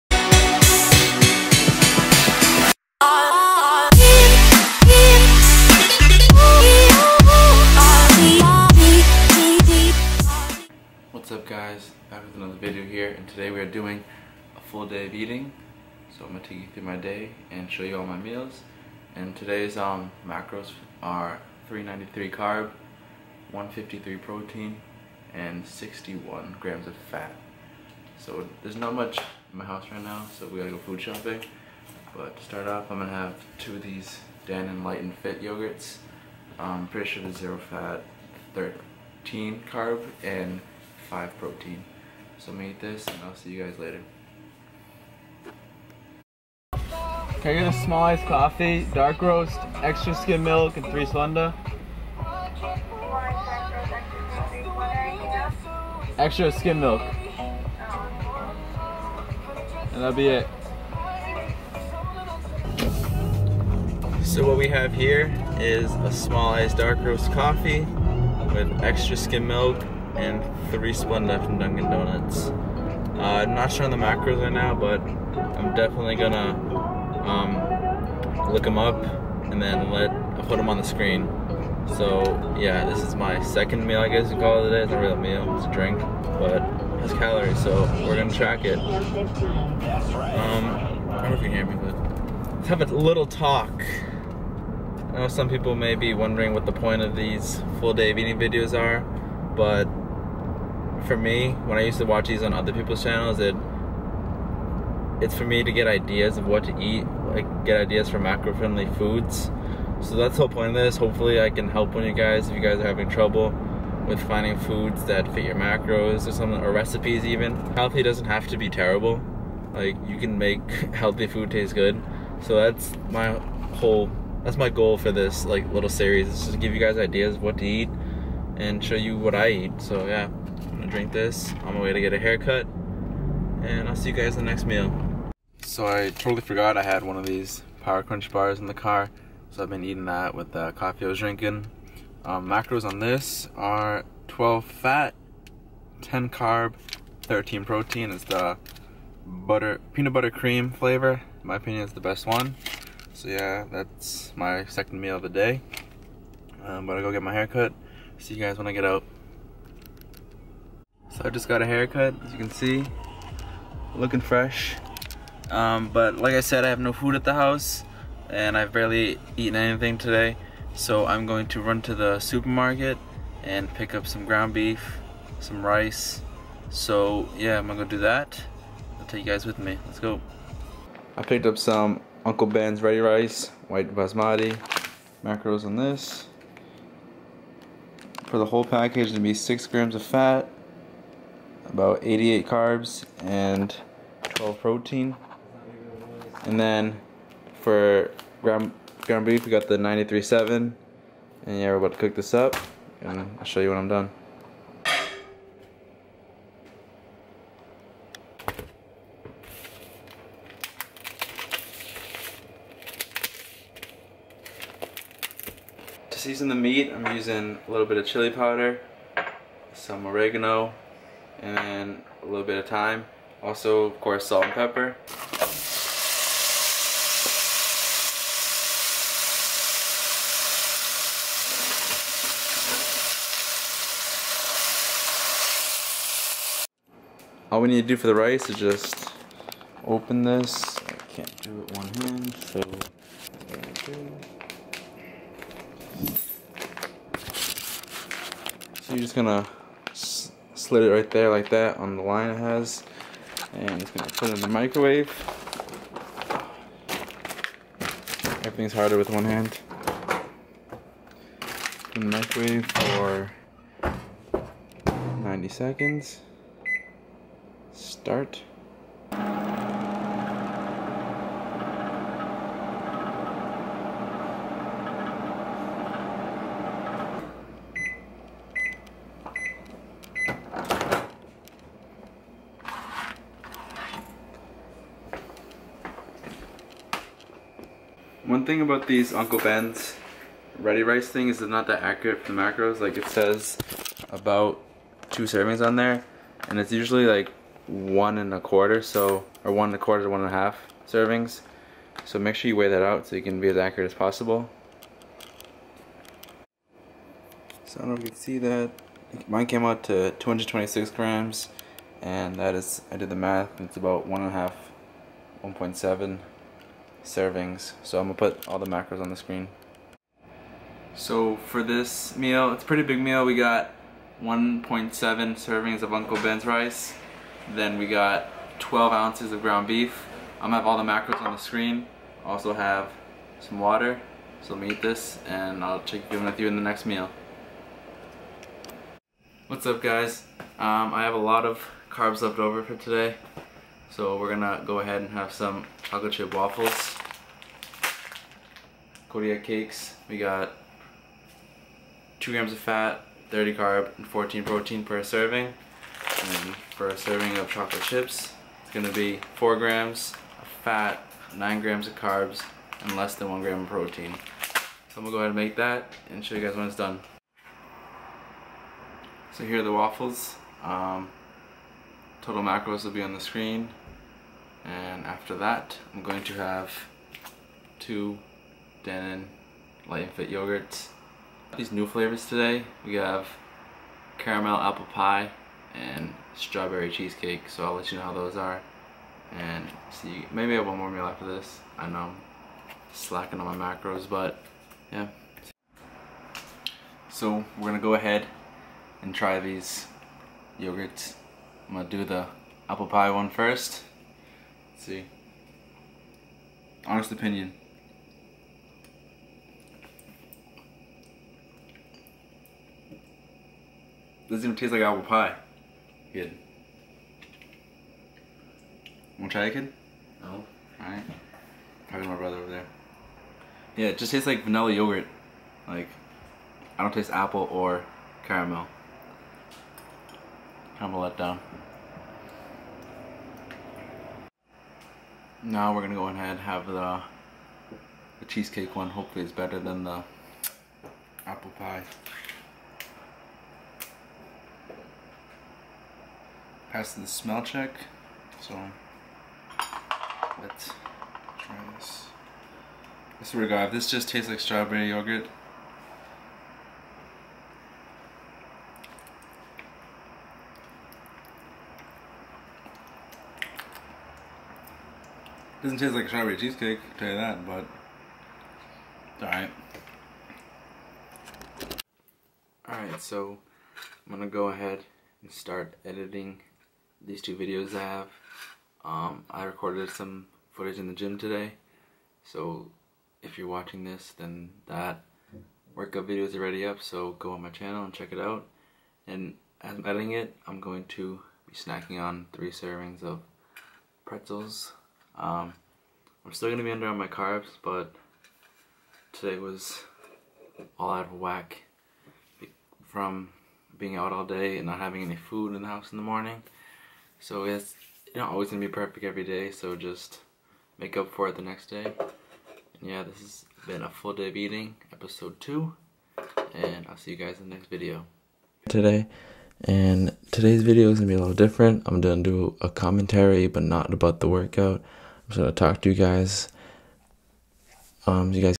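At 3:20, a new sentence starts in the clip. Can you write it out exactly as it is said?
And yeah, we're about to cook this up, and I'll show you when I'm done.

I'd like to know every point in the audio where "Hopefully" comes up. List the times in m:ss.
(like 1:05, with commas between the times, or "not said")
1:50, 7:18.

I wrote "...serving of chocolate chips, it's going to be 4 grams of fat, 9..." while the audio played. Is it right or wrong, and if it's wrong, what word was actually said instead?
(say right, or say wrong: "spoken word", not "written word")
right.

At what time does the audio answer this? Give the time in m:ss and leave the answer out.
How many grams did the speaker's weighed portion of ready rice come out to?
5:10.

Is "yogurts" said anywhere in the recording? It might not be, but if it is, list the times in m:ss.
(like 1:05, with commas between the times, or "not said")
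0:35, 6:20, 6:40, 7:04, 7:34.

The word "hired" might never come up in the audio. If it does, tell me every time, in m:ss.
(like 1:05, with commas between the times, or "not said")
not said.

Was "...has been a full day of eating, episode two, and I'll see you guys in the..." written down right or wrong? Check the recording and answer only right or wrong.
right.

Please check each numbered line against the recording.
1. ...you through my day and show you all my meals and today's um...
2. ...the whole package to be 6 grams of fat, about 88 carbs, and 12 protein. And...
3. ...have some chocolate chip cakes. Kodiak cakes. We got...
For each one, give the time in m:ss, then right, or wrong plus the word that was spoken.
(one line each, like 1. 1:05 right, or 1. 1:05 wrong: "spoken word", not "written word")
1. 0:16 right
2. 3:08 right
3. 5:45 wrong: "waffles", not "cakes".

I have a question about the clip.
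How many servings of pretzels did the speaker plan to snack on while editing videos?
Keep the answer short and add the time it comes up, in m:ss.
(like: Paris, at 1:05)
3, at 8:12.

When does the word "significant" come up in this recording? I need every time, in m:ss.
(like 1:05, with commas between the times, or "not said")
not said.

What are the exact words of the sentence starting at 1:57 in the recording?
Healthy doesn't have to be terrible.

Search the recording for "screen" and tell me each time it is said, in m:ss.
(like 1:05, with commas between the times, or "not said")
1:20, 5:19, 5:31, 6:13.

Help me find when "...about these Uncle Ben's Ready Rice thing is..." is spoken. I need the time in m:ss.
4:48.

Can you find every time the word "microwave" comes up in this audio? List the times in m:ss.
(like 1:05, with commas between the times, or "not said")
4:14, 4:22.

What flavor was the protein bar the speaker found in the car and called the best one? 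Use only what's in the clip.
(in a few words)
Butter peanut butter cream.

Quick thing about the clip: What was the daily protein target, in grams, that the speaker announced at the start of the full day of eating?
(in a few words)
153.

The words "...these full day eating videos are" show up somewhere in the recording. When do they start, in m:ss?
1:37.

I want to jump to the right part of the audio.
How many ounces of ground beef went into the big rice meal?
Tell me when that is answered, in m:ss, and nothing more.
5:28.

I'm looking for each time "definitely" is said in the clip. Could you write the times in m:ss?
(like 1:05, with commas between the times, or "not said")
1:15.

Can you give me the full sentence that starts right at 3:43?
Also, of course, salt and pepper.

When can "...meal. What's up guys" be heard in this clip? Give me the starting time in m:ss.
5:36.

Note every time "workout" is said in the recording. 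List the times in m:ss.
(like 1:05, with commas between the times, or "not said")
8:05, 8:44.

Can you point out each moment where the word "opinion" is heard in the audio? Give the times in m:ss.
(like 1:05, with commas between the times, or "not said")
2:31, 6:47.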